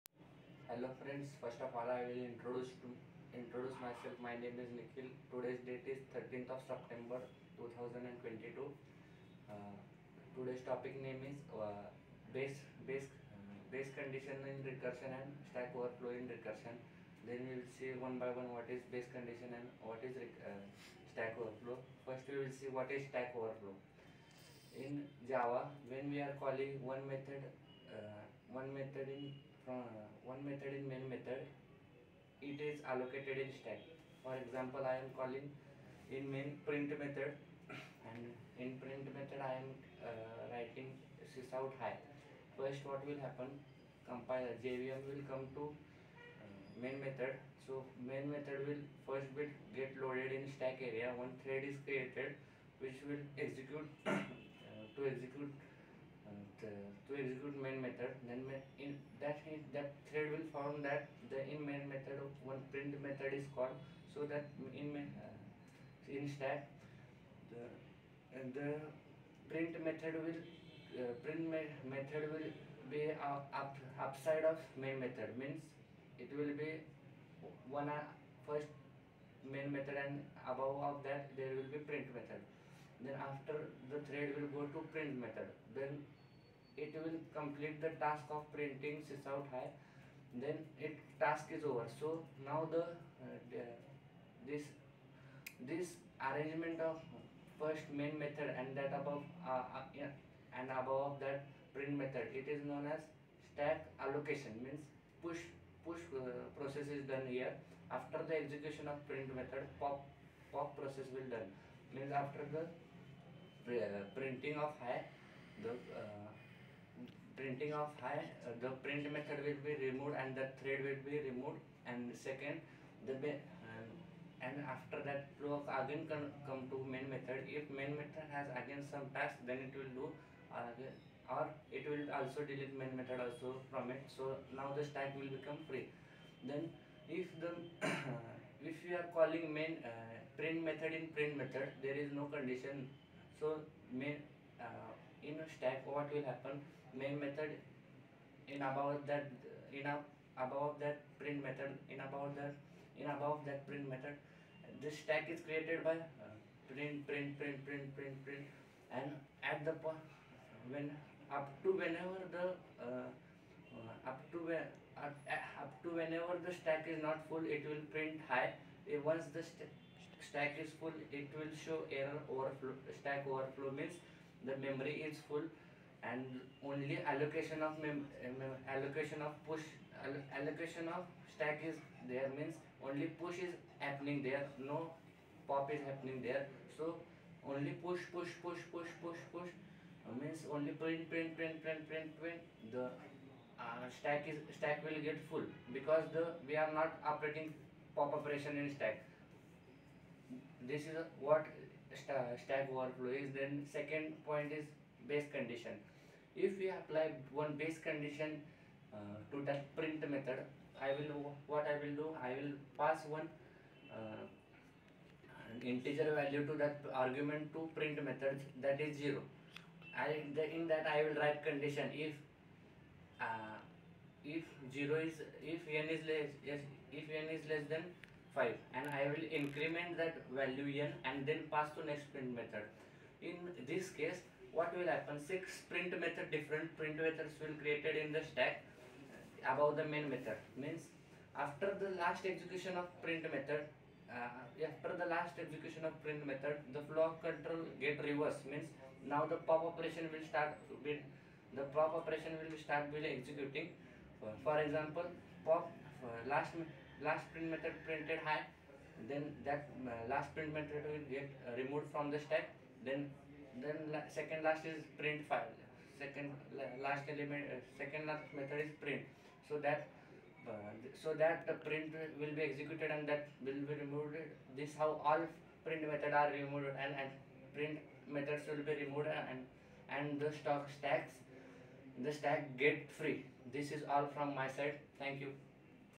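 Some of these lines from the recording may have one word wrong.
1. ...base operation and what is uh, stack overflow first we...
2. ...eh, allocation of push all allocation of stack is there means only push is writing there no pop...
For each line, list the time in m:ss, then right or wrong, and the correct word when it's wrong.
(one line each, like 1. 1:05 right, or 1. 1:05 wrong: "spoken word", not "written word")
1. 0:18 wrong: "condition", not "operation"
2. 2:58 wrong: "happening", not "writing".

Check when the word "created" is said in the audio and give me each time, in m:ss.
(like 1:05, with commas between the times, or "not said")
0:51, 2:35, 3:57.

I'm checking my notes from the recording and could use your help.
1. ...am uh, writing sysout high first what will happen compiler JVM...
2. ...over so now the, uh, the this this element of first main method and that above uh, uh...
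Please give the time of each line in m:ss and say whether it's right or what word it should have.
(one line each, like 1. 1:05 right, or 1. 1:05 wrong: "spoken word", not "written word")
1. 0:39 right
2. 1:31 wrong: "arrangement", not "element".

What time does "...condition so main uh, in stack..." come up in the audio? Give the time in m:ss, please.
2:22.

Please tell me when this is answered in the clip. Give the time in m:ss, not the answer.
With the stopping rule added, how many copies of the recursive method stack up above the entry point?
3:55.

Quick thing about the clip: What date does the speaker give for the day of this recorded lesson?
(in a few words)
13 September 2022.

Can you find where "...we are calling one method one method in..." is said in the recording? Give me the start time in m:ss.
0:26.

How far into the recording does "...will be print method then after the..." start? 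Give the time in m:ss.
1:21.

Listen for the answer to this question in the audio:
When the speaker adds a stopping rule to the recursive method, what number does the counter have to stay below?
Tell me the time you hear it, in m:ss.
3:48.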